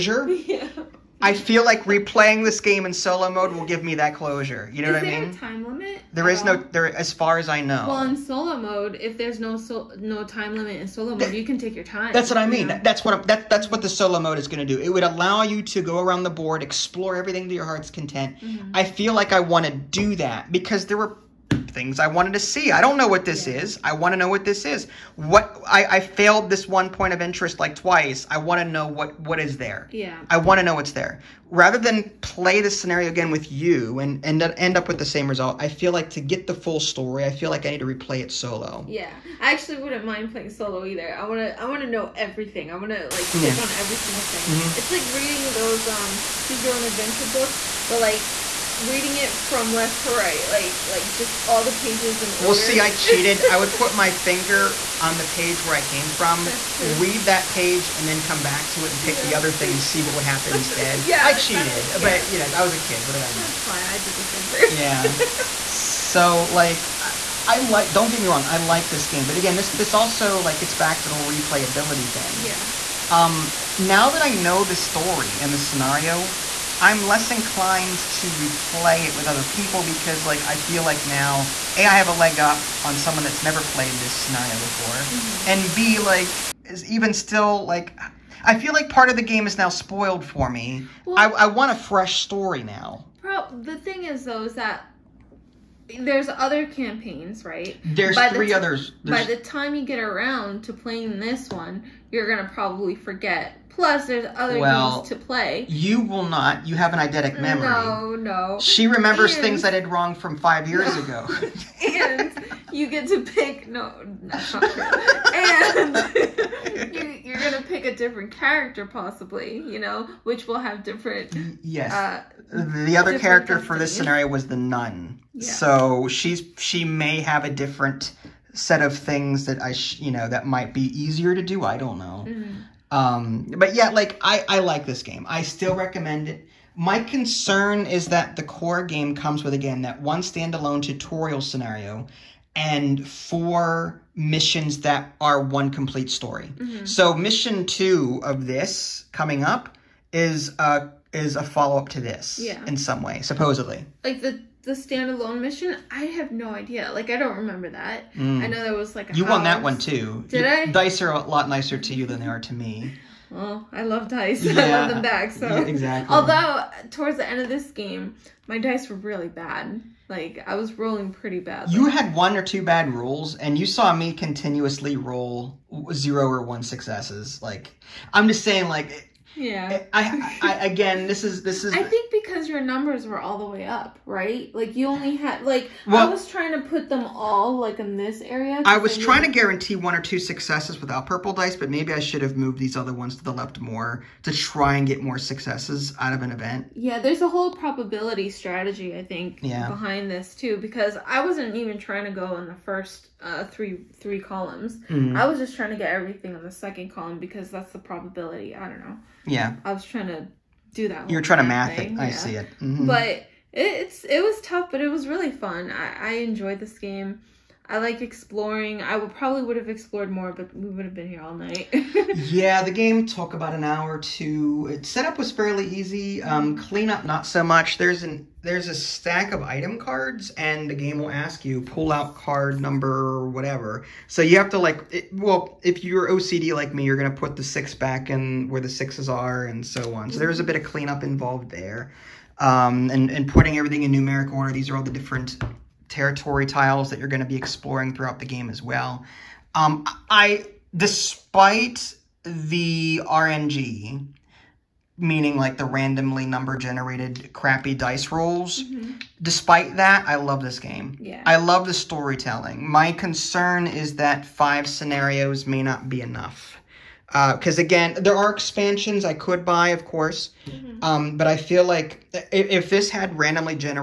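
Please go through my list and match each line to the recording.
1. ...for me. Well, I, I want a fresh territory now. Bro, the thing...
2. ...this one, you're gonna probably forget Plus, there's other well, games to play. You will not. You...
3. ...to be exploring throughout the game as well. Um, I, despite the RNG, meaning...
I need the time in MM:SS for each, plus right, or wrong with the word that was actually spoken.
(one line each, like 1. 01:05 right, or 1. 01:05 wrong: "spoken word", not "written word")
1. 01:30 wrong: "story", not "territory"
2. 01:41 right
3. 04:07 right.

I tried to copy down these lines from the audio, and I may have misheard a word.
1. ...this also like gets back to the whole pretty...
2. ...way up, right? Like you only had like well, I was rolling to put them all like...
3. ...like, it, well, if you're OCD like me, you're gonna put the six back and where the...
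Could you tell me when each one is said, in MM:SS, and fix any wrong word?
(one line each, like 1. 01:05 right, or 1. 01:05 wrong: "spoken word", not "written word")
1. 01:09 wrong: "replayability", not "pretty"
2. 03:03 wrong: "trying", not "rolling"
3. 03:54 right.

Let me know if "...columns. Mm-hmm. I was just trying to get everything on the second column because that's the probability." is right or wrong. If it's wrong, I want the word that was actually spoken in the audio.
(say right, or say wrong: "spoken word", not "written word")
right.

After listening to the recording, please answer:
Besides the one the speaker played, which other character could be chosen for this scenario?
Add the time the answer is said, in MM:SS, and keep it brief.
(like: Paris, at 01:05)
The nun, at 02:04.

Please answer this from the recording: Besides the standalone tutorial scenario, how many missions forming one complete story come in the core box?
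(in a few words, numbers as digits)
4.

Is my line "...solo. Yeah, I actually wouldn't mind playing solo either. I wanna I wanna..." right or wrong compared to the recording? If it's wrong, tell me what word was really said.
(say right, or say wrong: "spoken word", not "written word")
right.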